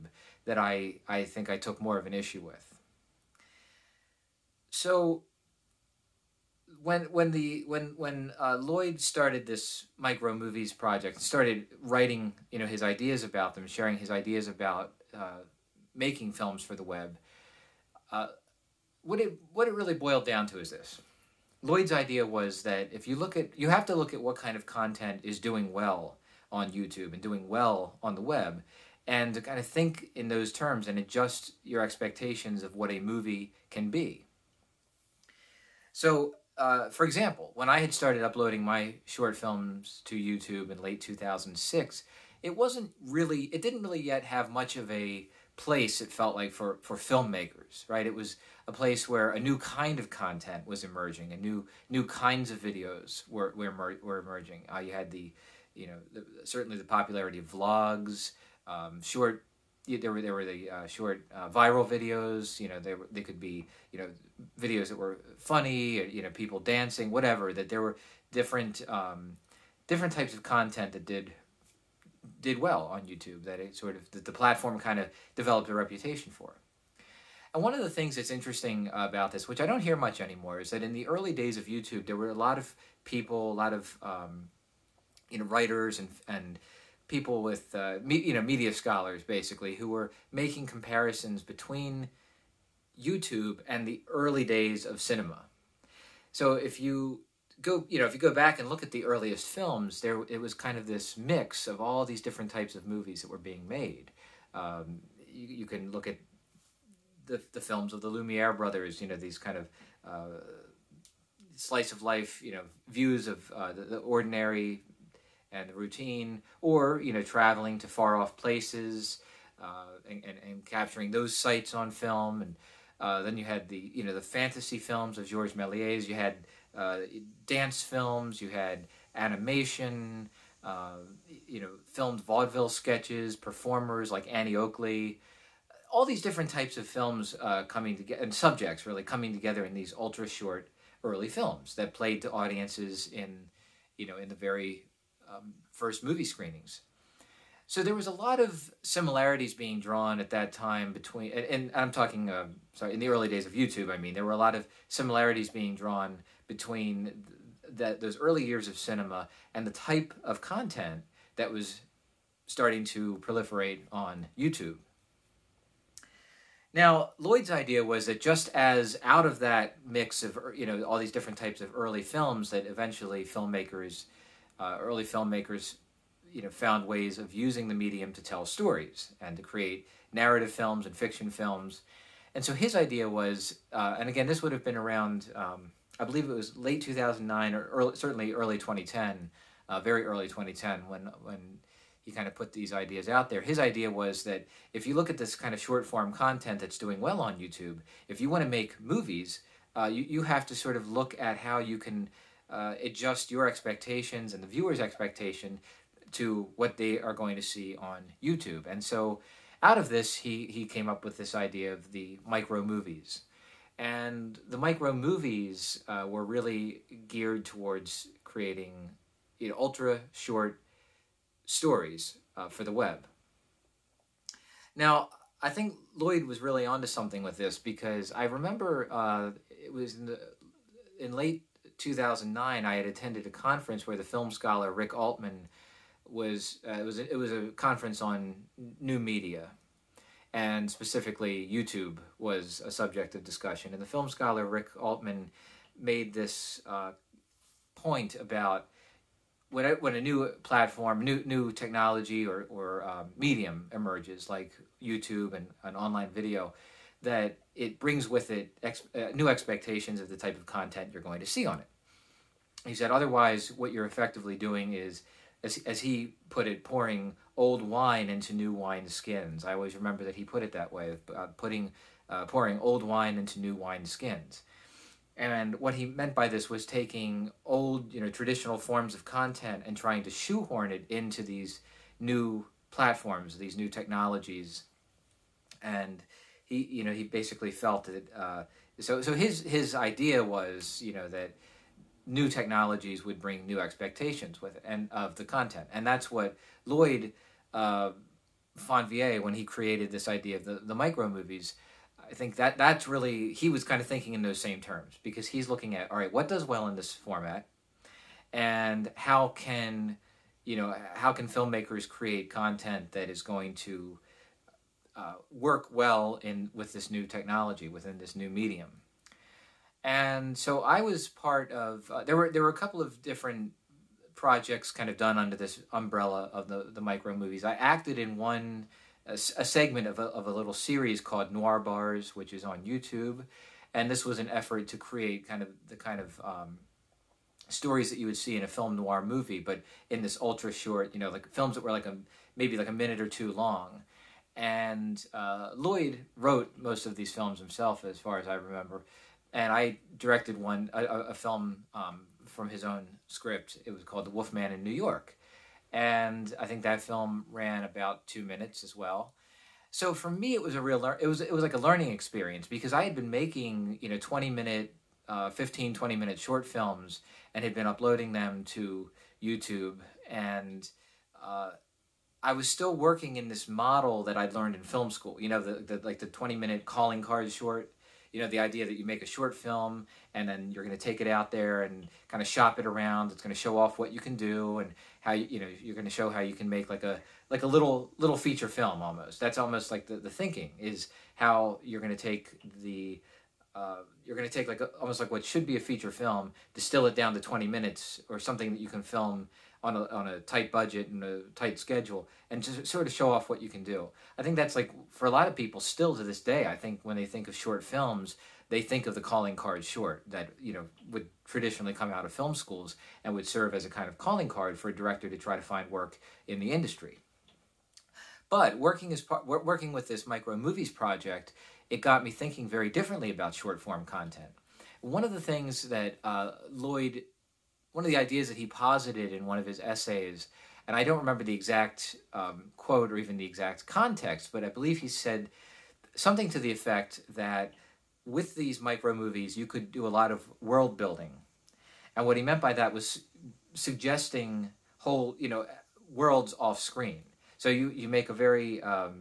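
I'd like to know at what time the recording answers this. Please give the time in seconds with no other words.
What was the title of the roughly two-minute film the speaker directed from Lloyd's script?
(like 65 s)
354 s.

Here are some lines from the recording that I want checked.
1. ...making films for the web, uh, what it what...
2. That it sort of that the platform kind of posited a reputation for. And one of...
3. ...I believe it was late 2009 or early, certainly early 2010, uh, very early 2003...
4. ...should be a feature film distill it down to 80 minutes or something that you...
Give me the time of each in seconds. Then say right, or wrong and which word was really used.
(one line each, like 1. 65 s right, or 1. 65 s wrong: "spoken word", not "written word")
1. 15 s right
2. 73 s wrong: "developed", not "posited"
3. 185 s wrong: "2010", not "2003"
4. 395 s wrong: "20", not "80".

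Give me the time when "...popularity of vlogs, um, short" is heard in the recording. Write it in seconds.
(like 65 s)
56 s.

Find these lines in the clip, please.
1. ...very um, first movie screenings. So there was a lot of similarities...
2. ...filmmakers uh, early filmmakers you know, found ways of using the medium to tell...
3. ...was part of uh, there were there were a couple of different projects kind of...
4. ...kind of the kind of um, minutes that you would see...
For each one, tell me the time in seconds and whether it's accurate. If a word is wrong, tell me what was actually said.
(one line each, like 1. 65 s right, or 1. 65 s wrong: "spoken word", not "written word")
1. 144 s right
2. 173 s right
3. 320 s right
4. 335 s wrong: "stories", not "minutes".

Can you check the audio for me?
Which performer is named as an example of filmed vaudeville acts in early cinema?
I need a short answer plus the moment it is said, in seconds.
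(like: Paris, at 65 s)
Annie Oakley, at 134 s.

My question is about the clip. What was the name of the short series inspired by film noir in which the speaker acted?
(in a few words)
Noir Bars.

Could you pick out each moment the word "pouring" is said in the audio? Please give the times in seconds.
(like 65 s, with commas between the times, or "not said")
266 s, 272 s.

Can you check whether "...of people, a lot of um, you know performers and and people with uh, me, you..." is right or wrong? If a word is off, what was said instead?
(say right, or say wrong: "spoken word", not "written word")
wrong: "writers", not "performers".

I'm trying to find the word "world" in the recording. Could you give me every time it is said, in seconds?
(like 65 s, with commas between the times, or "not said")
440 s, 445 s.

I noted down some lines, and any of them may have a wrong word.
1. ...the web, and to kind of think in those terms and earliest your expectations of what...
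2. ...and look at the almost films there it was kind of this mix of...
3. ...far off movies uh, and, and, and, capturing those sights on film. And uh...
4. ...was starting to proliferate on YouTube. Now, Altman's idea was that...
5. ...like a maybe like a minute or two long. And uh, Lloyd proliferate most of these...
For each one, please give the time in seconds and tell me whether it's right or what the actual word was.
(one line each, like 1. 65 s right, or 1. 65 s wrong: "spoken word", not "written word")
1. 28 s wrong: "adjust", not "earliest"
2. 98 s wrong: "earliest", not "almost"
3. 117 s wrong: "places", not "movies"
4. 161 s wrong: "Lloyd", not "Altman"
5. 341 s wrong: "wrote", not "proliferate".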